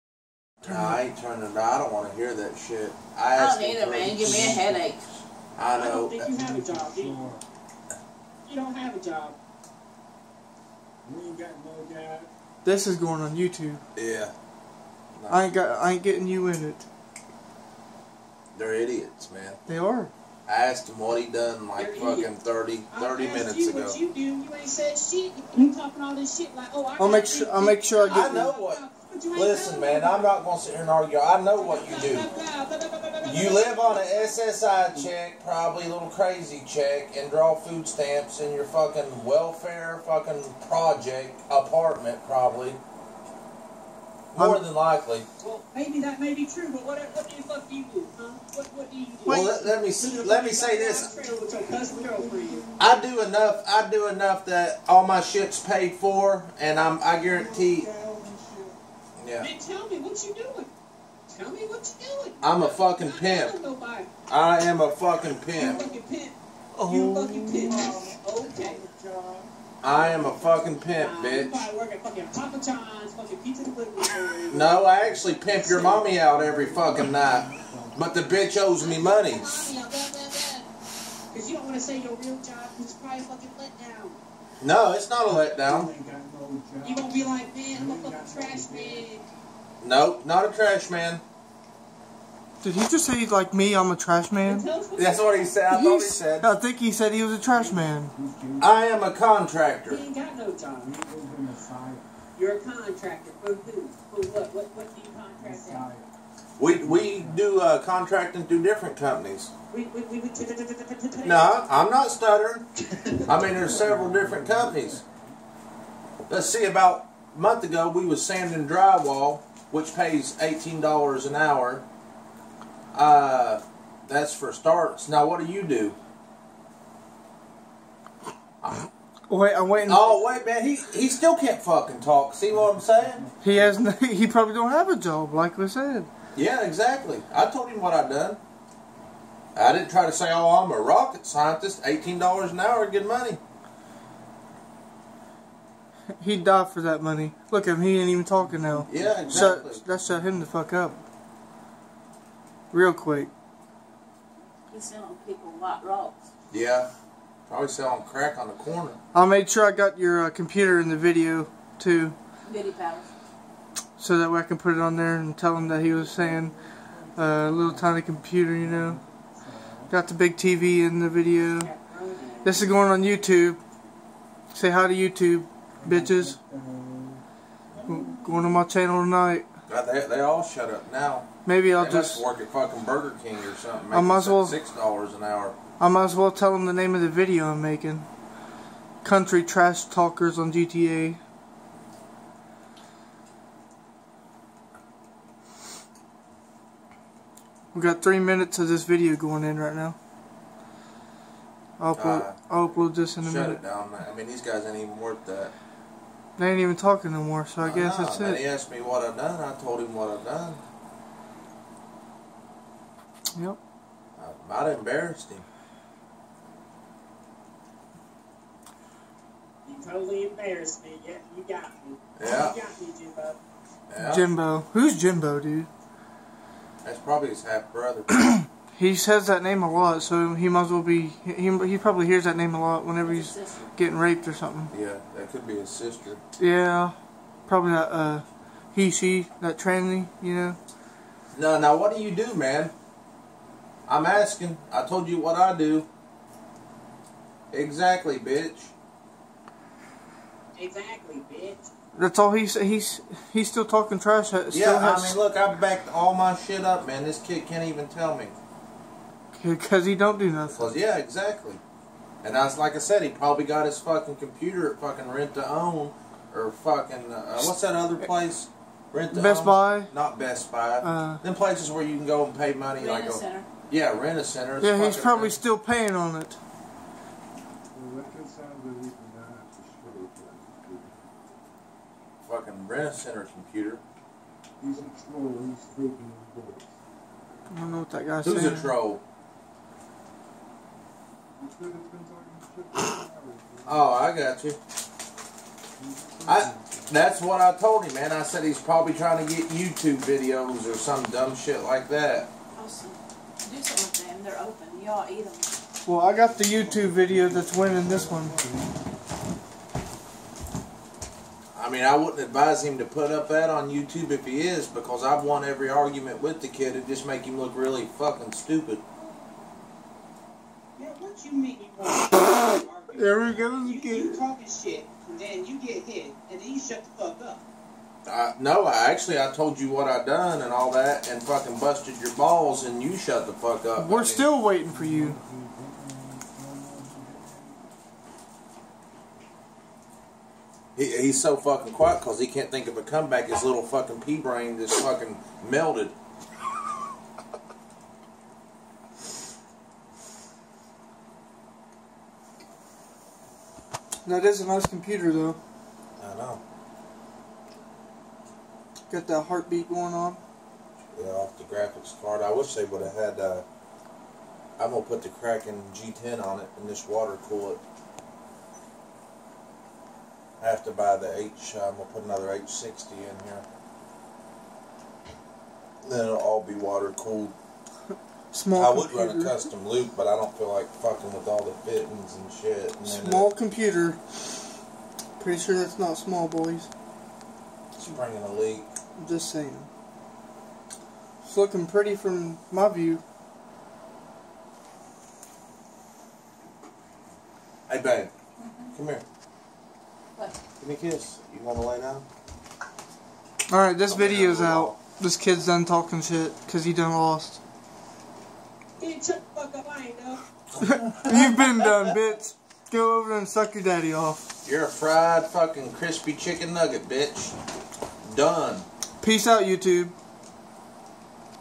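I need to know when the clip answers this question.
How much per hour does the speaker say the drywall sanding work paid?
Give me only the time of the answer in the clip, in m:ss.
2:00.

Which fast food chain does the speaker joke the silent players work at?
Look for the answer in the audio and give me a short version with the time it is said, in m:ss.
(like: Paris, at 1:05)
Burger King, at 3:02.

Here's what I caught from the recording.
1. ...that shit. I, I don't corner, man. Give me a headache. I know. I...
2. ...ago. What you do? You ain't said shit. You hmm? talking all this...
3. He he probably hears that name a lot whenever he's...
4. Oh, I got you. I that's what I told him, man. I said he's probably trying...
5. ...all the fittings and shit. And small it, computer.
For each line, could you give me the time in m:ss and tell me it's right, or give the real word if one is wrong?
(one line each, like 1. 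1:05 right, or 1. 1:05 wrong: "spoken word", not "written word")
1. 0:02 wrong: "either", not "corner"
2. 0:23 right
3. 3:51 right
4. 4:53 right
5. 6:21 right.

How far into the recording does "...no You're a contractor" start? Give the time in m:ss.
1:40.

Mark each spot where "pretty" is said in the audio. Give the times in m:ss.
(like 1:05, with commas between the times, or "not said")
6:25, 6:31.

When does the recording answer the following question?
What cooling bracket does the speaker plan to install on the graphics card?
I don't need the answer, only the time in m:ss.
6:05.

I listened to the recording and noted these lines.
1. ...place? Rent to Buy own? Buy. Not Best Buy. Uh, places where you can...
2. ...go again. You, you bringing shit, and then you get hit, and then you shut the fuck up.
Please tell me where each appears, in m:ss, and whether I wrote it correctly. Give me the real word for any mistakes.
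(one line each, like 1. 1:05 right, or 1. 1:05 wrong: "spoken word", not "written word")
1. 4:27 wrong: "Best", not "Buy"
2. 5:23 wrong: "talking", not "bringing".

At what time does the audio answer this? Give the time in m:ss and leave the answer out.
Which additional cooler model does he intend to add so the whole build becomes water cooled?
6:12.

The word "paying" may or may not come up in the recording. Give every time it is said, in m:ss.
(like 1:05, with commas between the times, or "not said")
4:35.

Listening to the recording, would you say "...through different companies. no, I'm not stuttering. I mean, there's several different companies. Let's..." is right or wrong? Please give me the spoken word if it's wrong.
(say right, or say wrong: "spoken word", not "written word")
right.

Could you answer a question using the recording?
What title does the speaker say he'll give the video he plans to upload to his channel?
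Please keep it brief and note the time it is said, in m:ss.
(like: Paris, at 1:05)
Country trash talkers on GTA, at 3:09.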